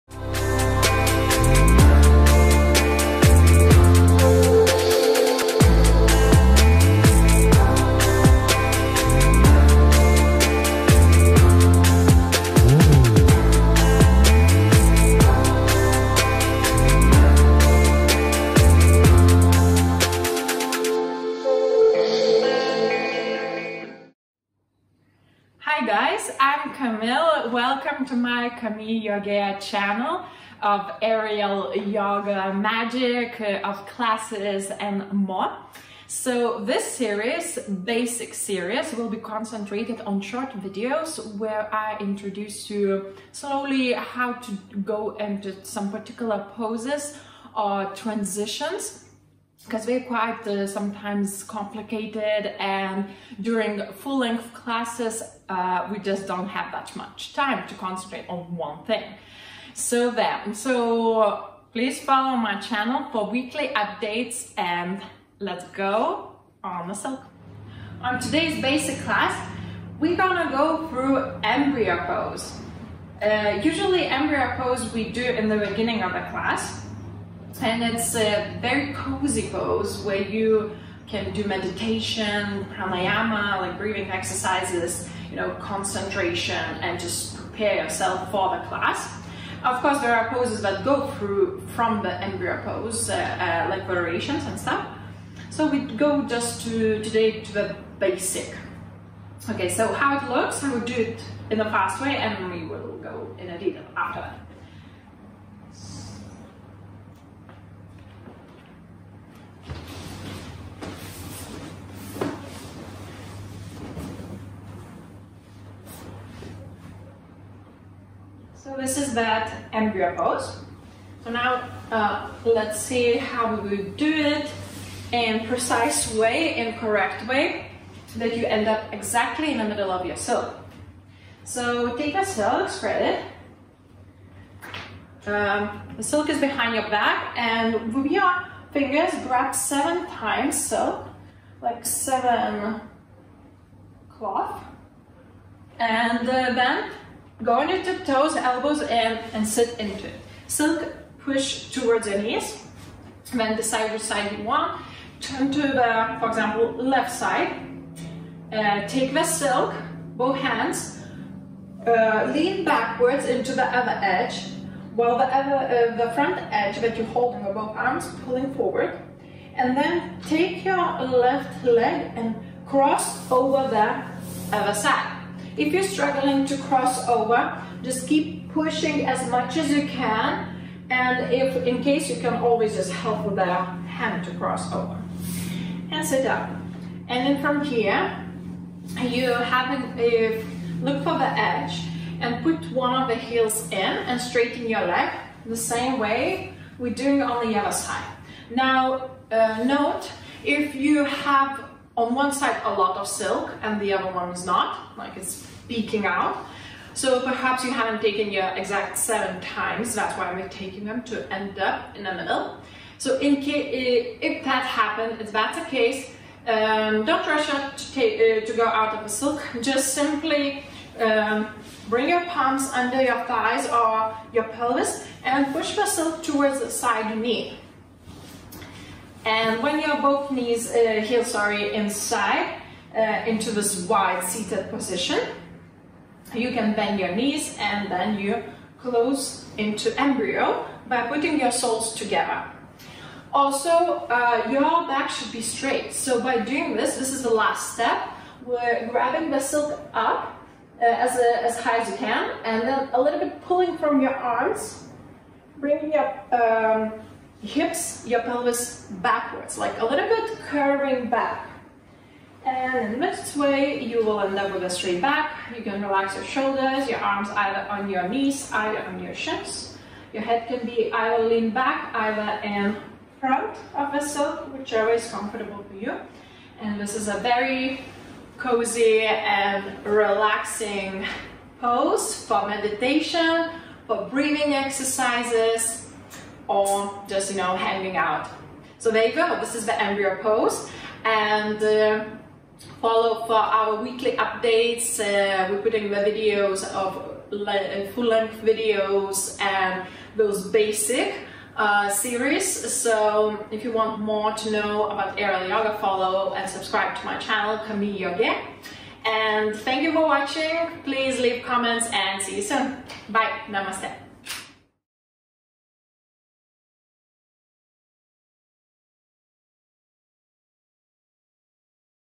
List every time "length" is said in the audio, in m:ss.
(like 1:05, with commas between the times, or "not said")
0:53, 4:57.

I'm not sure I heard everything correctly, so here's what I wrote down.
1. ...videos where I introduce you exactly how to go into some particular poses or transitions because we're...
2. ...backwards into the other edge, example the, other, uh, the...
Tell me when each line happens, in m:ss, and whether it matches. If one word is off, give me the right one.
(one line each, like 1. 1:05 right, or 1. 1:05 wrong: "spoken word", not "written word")
1. 0:40 wrong: "slowly", not "exactly"
2. 2:42 wrong: "while", not "example".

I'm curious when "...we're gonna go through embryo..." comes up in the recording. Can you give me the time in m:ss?
1:09.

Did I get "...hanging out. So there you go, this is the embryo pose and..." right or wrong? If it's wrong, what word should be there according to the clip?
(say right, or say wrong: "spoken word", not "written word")
right.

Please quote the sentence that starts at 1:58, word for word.
So this is that embryo pose.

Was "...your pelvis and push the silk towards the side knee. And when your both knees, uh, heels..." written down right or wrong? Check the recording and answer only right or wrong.
right.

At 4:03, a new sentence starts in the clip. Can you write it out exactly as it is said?
Also, uh, your back should be straight.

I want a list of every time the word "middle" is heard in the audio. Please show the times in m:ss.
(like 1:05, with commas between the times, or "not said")
2:09, 3:32.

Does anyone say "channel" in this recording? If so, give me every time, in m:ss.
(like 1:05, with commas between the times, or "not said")
0:29, 1:02, 5:07.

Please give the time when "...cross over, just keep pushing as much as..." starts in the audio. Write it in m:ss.
2:56.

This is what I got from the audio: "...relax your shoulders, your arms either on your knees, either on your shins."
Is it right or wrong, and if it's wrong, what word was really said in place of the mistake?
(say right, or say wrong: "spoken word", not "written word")
right.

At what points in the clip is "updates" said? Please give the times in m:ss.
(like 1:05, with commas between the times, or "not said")
1:03, 4:54.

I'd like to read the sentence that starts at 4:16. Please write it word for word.
Um, hips, your pelvis backwards, like a little bit curving back.